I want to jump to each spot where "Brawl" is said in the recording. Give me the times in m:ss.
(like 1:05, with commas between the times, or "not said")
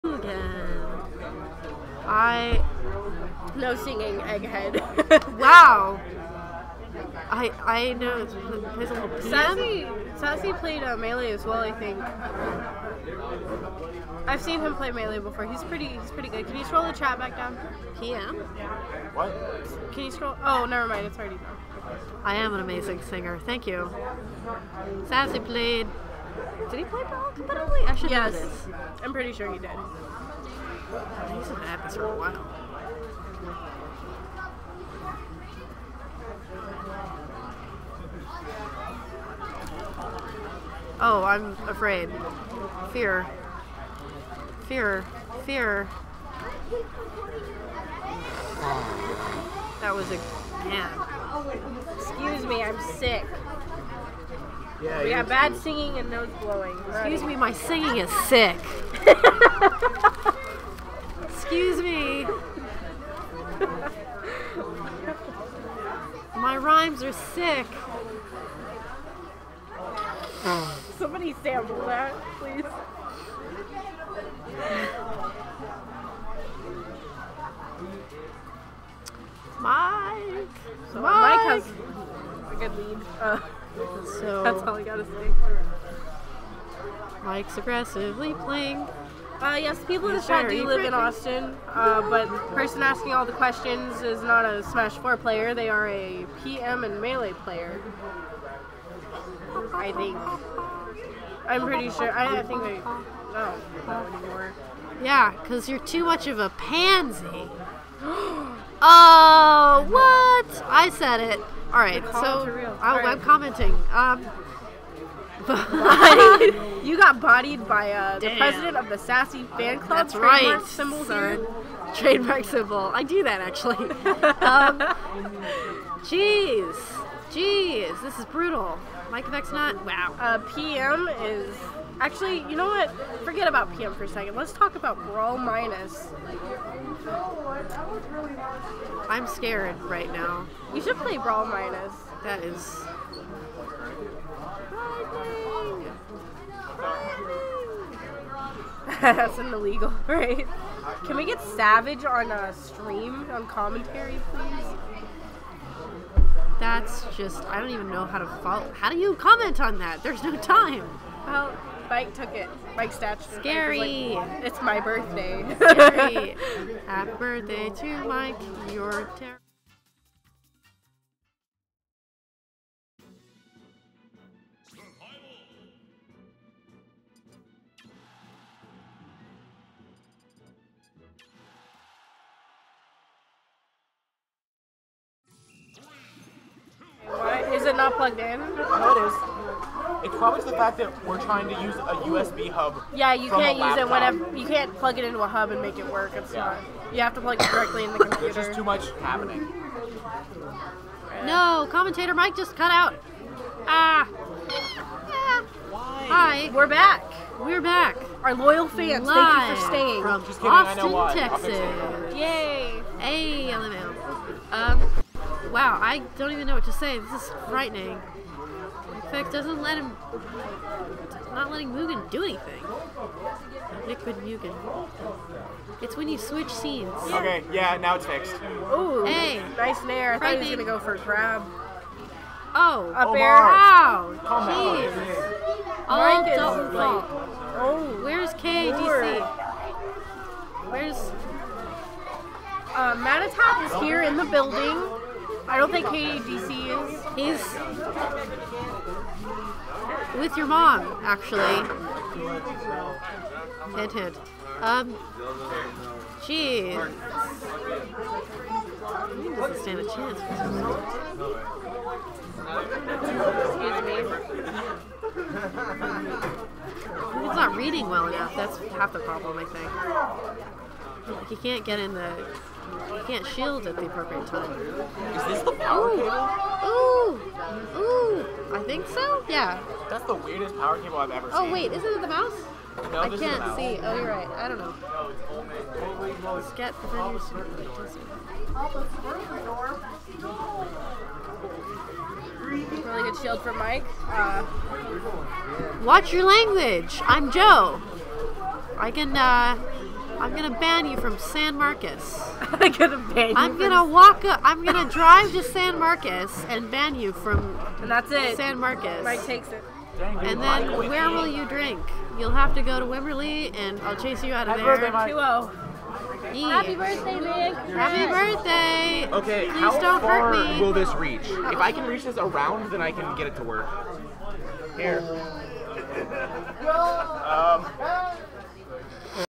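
2:15, 2:21.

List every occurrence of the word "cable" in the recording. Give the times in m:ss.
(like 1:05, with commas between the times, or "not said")
4:35, 4:40.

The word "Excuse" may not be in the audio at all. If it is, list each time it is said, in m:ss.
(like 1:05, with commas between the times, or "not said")
0:51, 0:56, 1:01, 4:24.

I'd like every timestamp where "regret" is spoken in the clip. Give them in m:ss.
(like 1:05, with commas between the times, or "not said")
not said.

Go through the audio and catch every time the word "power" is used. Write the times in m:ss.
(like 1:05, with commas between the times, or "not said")
4:35, 4:40.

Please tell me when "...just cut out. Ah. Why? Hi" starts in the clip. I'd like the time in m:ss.
3:22.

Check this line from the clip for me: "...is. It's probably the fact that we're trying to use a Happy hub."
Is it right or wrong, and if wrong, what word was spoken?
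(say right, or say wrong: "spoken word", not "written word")
wrong: "USB", not "Happy".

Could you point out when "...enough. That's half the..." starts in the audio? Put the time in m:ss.
4:28.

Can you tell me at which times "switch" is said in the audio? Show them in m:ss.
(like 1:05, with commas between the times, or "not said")
3:46.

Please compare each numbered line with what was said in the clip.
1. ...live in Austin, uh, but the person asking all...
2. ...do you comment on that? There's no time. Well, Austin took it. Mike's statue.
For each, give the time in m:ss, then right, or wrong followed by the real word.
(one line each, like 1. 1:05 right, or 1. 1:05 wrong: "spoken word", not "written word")
1. 1:30 right
2. 2:38 wrong: "Mike", not "Austin".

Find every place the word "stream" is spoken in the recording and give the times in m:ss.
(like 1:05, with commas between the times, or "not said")
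2:32.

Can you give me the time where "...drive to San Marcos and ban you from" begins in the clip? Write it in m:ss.
5:04.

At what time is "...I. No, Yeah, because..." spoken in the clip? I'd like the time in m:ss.
1:42.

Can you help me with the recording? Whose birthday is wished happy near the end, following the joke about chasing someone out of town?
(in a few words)
Nick.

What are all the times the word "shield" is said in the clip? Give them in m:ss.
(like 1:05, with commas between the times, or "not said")
4:33, 4:53.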